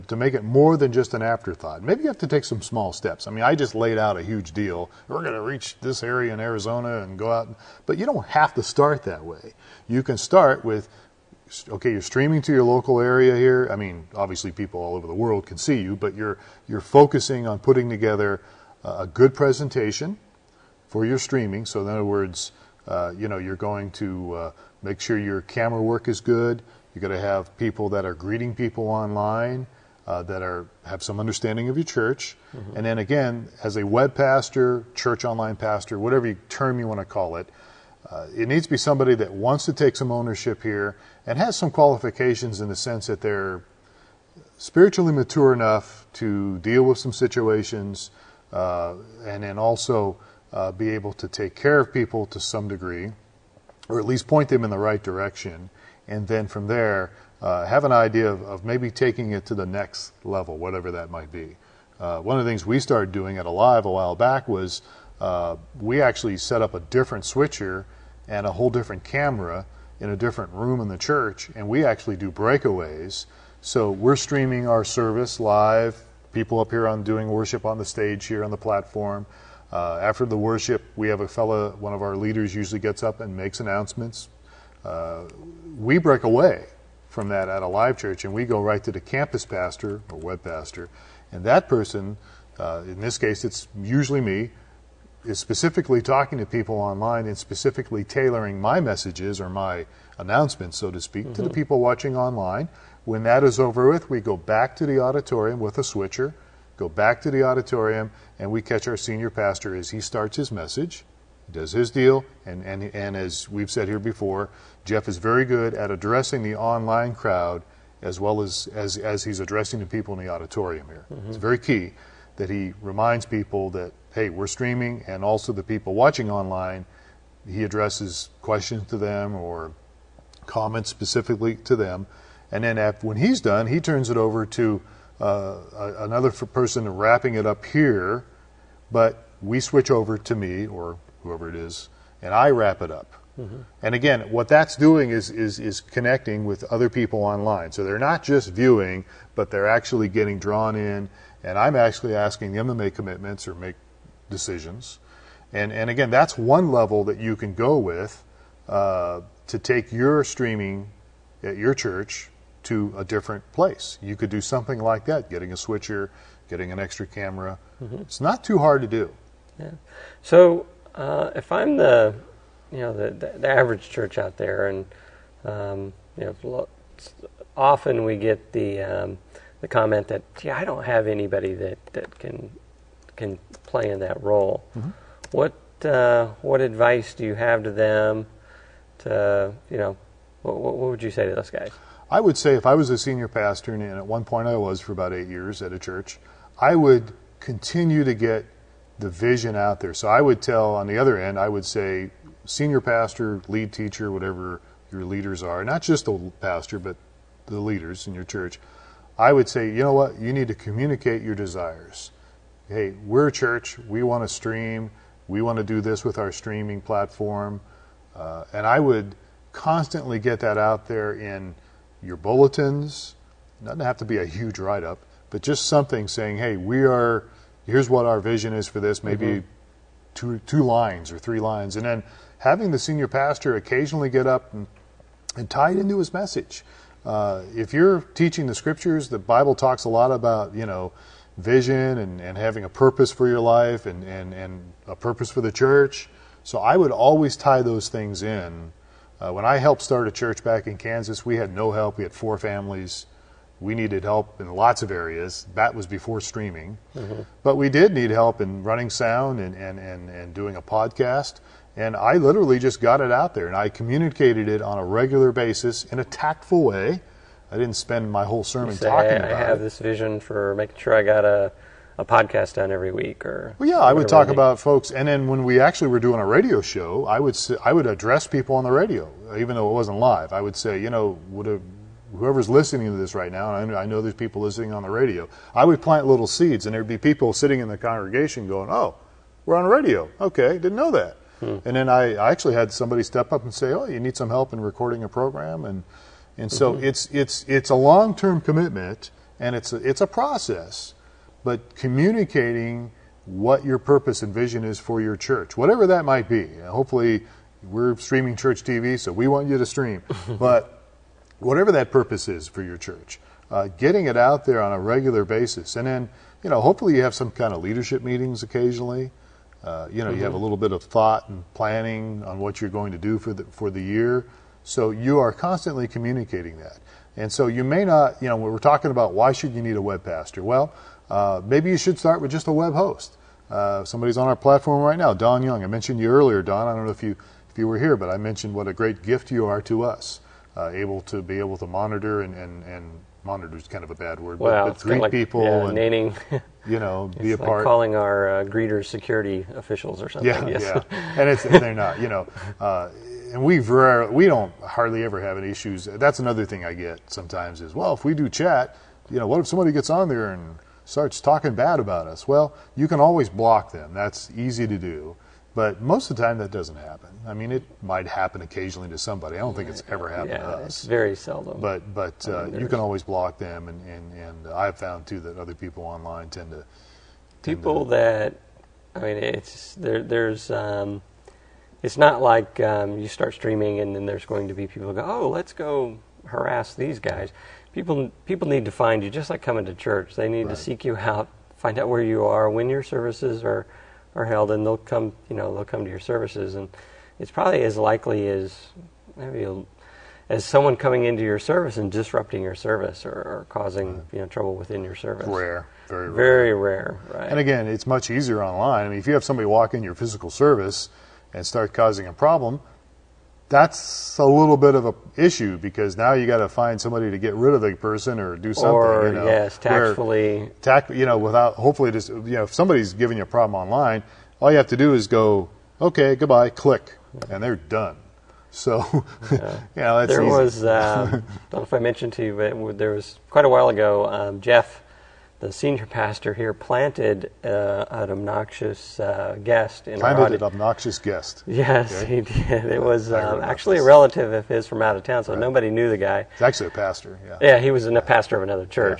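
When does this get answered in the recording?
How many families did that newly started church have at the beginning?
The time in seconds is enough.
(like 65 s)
252 s.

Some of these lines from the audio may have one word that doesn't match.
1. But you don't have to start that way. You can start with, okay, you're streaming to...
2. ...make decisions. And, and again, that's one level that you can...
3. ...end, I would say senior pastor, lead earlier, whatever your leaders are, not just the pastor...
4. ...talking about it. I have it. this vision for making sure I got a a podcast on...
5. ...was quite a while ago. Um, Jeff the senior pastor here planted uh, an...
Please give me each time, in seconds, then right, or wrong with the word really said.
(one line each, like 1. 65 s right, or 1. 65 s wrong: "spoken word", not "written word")
1. 7 s right
2. 153 s right
3. 201 s wrong: "teacher", not "earlier"
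4. 268 s right
5. 432 s right.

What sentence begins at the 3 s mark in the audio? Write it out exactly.
I mean, I just laid out a huge deal.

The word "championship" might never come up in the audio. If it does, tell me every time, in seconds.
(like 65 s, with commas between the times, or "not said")
not said.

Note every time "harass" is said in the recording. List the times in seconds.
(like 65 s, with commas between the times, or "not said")
386 s.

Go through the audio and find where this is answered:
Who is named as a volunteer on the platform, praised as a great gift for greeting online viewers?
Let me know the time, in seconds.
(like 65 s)
335 s.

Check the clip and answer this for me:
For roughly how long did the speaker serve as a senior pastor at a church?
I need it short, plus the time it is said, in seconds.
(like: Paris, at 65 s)
8 years, at 195 s.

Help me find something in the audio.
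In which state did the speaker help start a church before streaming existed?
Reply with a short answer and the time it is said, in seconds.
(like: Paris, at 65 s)
Kansas, at 250 s.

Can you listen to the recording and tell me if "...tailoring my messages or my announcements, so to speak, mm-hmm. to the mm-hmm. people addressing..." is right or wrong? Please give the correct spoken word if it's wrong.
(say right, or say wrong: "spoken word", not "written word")
wrong: "watching", not "addressing".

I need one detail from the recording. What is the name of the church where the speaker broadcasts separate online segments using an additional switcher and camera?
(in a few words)
Alive Church.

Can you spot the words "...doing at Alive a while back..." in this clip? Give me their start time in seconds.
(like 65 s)
63 s.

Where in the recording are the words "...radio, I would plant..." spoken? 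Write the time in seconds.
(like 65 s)
284 s.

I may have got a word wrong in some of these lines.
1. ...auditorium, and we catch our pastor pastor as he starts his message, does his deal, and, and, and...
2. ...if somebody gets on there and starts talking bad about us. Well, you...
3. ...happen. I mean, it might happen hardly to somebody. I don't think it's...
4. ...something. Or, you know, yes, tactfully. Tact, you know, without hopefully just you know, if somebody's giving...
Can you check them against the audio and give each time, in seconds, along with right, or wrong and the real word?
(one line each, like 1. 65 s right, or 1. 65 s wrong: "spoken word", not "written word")
1. 107 s wrong: "senior", not "pastor"
2. 359 s right
3. 366 s wrong: "occasionally", not "hardly"
4. 418 s right.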